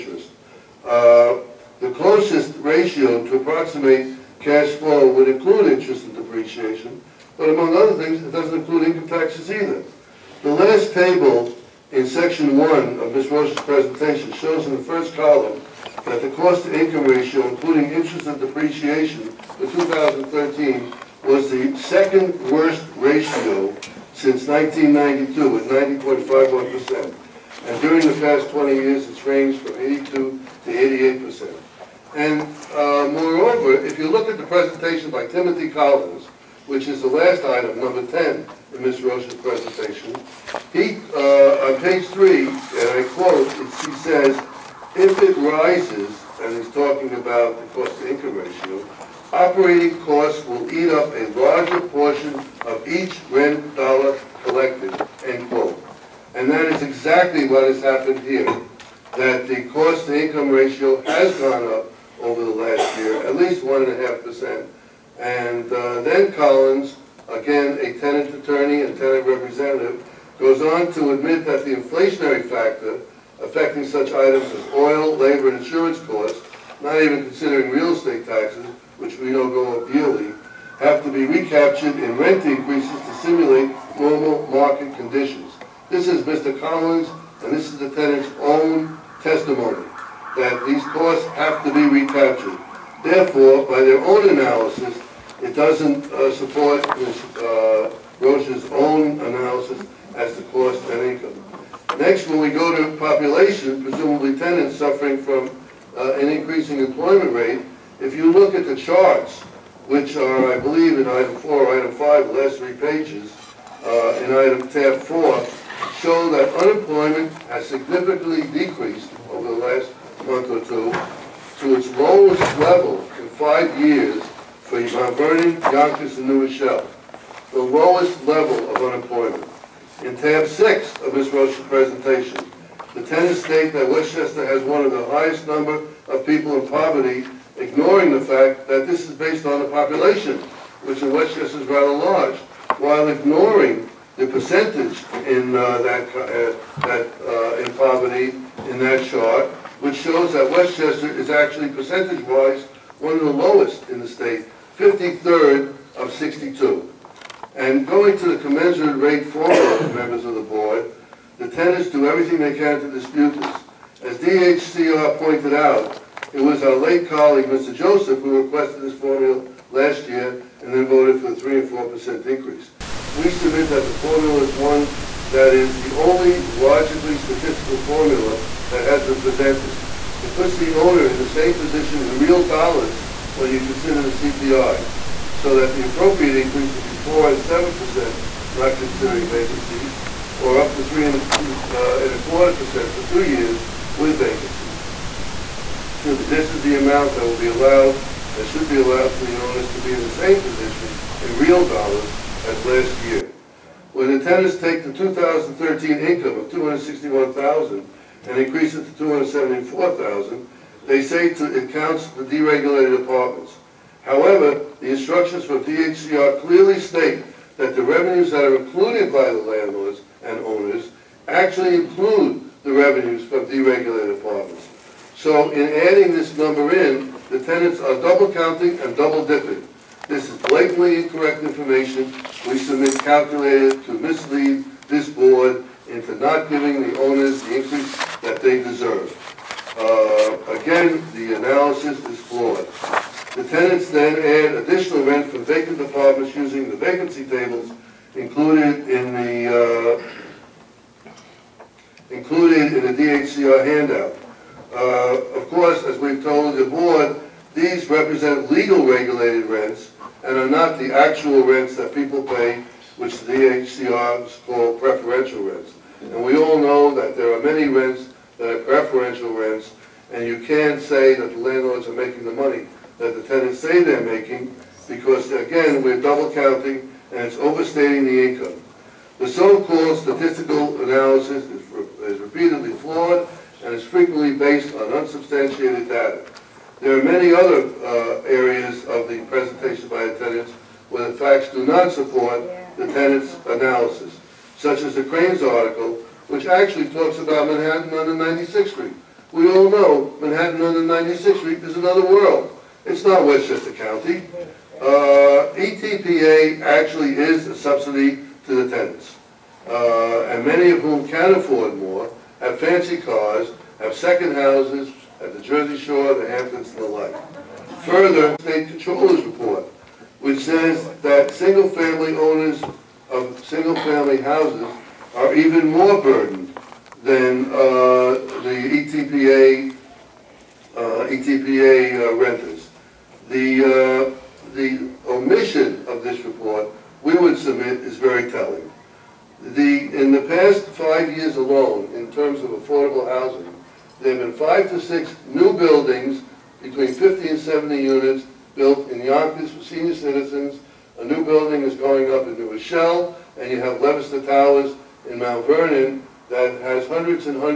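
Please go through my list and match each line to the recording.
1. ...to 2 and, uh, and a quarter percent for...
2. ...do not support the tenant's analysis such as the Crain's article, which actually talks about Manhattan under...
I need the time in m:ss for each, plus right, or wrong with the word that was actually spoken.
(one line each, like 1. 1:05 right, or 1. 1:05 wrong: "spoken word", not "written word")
1. 3:10 wrong: "3", not "2"
2. 4:51 right.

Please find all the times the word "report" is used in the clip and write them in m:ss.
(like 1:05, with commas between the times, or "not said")
5:19, 5:36.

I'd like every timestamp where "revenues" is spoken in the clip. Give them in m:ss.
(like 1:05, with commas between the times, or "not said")
3:37, 3:42.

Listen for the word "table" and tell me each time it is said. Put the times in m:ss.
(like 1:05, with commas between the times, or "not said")
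0:10, 4:07.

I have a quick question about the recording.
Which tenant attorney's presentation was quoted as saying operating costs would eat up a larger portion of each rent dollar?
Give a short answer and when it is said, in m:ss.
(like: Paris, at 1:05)
Timothy Collins, at 0:35.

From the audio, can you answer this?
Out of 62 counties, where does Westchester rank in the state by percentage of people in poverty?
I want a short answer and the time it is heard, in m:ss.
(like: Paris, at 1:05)
53rd, at 2:34.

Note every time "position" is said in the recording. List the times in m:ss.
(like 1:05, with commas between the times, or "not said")
3:01, 3:20.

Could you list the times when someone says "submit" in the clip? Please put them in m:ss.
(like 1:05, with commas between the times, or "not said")
2:53, 3:52, 5:37.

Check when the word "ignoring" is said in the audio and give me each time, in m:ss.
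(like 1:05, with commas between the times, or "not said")
2:17, 2:23.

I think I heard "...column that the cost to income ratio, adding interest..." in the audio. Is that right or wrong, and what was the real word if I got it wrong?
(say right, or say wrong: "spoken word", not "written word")
wrong: "including", not "adding".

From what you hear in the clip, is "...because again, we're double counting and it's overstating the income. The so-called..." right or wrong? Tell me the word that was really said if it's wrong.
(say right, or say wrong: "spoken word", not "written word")
right.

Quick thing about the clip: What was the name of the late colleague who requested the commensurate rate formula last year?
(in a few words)
Mr. Joseph.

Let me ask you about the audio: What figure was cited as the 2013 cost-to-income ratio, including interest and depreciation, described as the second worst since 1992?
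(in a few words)
90.51%.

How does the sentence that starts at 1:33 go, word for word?
Therefore, by their own analysis, it doesn't uh, support Ms.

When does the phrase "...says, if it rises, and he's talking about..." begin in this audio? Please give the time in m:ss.
0:43.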